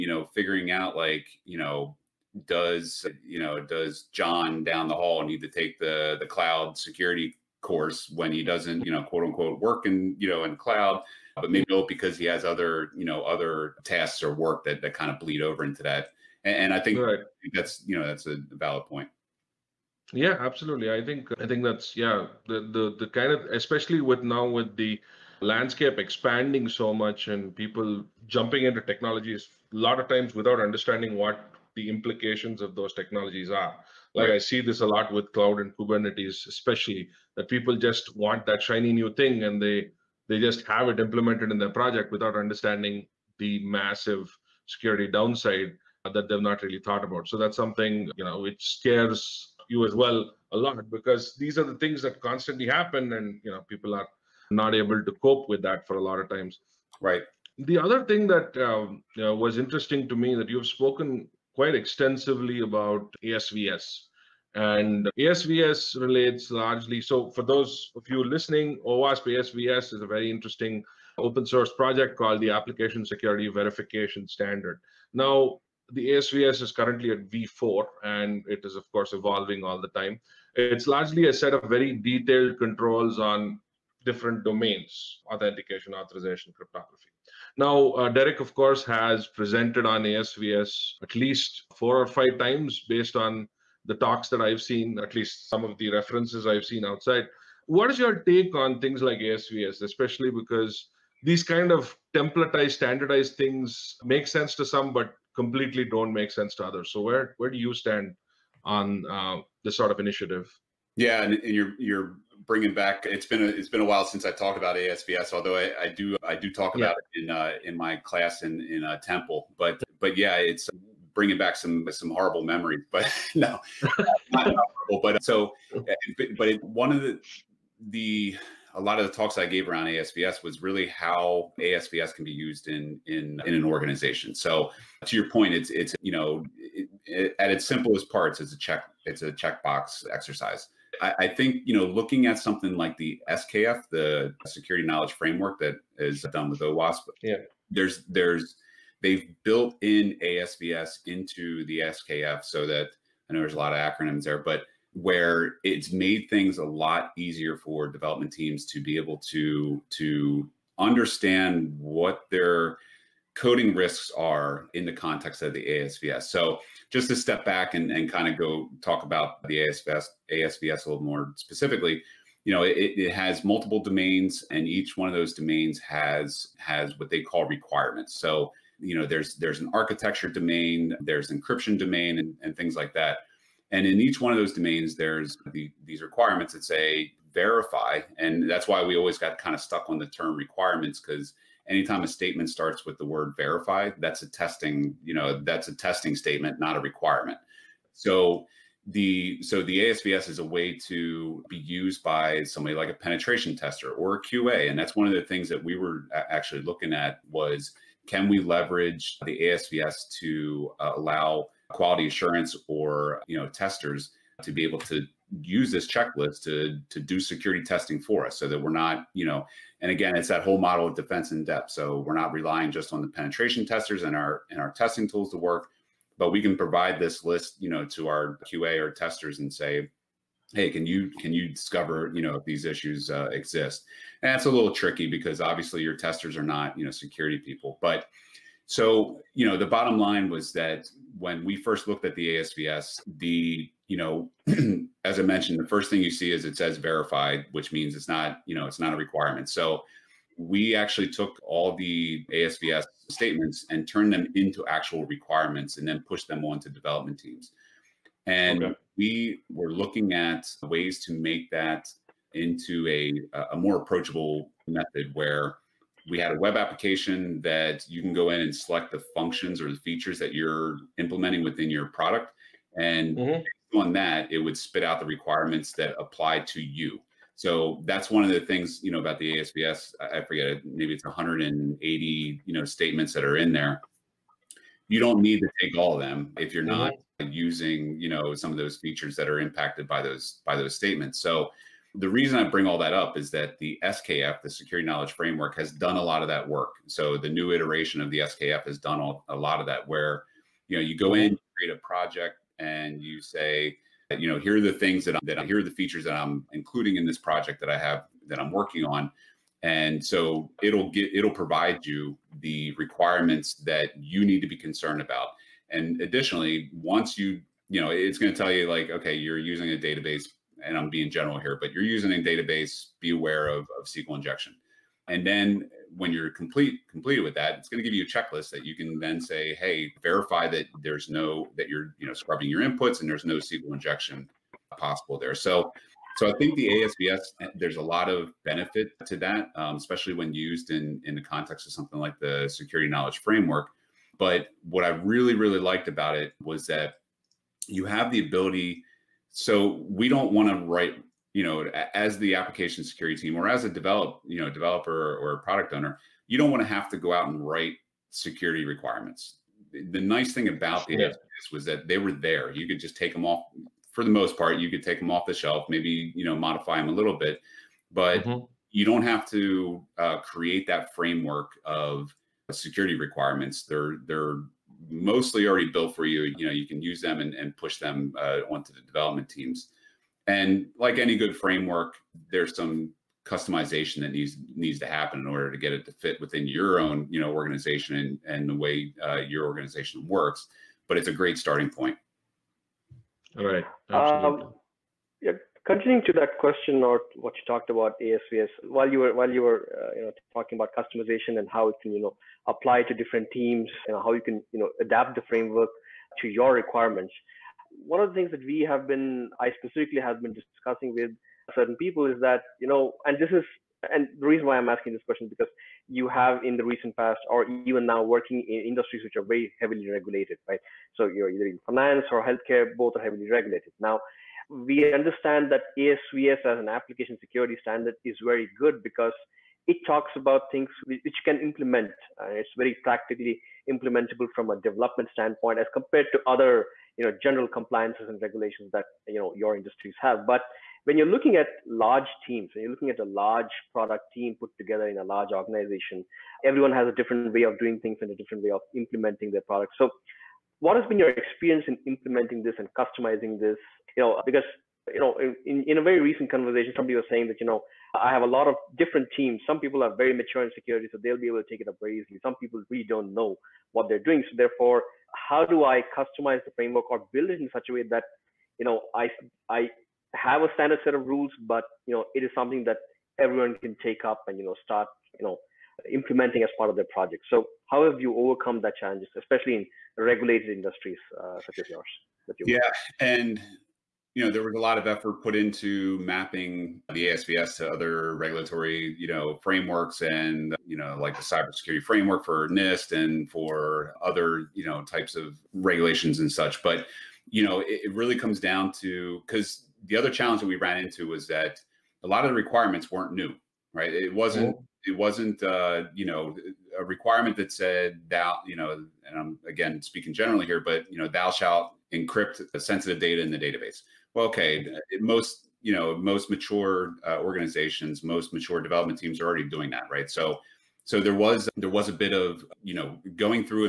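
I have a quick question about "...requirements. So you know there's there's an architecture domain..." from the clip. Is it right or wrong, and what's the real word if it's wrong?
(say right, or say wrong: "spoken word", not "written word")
right.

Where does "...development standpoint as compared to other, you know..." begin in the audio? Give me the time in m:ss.
7:14.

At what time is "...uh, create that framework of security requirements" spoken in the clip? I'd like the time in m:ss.
6:09.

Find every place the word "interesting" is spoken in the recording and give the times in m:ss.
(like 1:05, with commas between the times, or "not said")
0:59, 1:10.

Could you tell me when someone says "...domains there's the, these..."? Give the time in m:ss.
3:04.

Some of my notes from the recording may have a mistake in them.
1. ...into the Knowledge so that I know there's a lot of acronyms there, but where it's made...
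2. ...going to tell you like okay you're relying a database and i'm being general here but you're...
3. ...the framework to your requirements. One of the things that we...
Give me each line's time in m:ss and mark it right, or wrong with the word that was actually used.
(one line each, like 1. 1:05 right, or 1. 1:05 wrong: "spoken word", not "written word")
1. 2:31 wrong: "SKF", not "Knowledge"
2. 5:18 wrong: "using", not "relying"
3. 6:45 right.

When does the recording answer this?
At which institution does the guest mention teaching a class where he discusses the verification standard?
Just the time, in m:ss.
1:58.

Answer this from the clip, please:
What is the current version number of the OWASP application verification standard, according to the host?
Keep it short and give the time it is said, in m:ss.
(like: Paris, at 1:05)
V4, at 1:17.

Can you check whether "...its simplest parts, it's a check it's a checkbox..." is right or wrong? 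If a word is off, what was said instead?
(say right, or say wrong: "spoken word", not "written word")
right.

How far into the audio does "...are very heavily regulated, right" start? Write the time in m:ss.
6:59.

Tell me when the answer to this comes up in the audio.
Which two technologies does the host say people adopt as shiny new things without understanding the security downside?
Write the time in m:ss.
0:35.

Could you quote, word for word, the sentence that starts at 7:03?
Now, we understand that ASVS as an application security standard is very good because it talks about things which can implement.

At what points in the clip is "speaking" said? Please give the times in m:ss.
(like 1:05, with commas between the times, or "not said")
8:29.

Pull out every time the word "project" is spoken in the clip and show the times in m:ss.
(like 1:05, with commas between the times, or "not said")
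0:41, 1:11, 5:01, 5:07, 7:56.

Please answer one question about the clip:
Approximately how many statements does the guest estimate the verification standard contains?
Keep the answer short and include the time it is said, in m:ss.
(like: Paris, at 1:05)
180, at 4:41.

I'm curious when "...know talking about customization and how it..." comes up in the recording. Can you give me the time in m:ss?
6:40.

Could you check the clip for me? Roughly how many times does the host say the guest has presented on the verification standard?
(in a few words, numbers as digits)
four or five times.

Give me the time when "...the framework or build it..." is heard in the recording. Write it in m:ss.
7:46.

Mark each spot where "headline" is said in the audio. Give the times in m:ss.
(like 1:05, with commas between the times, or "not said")
not said.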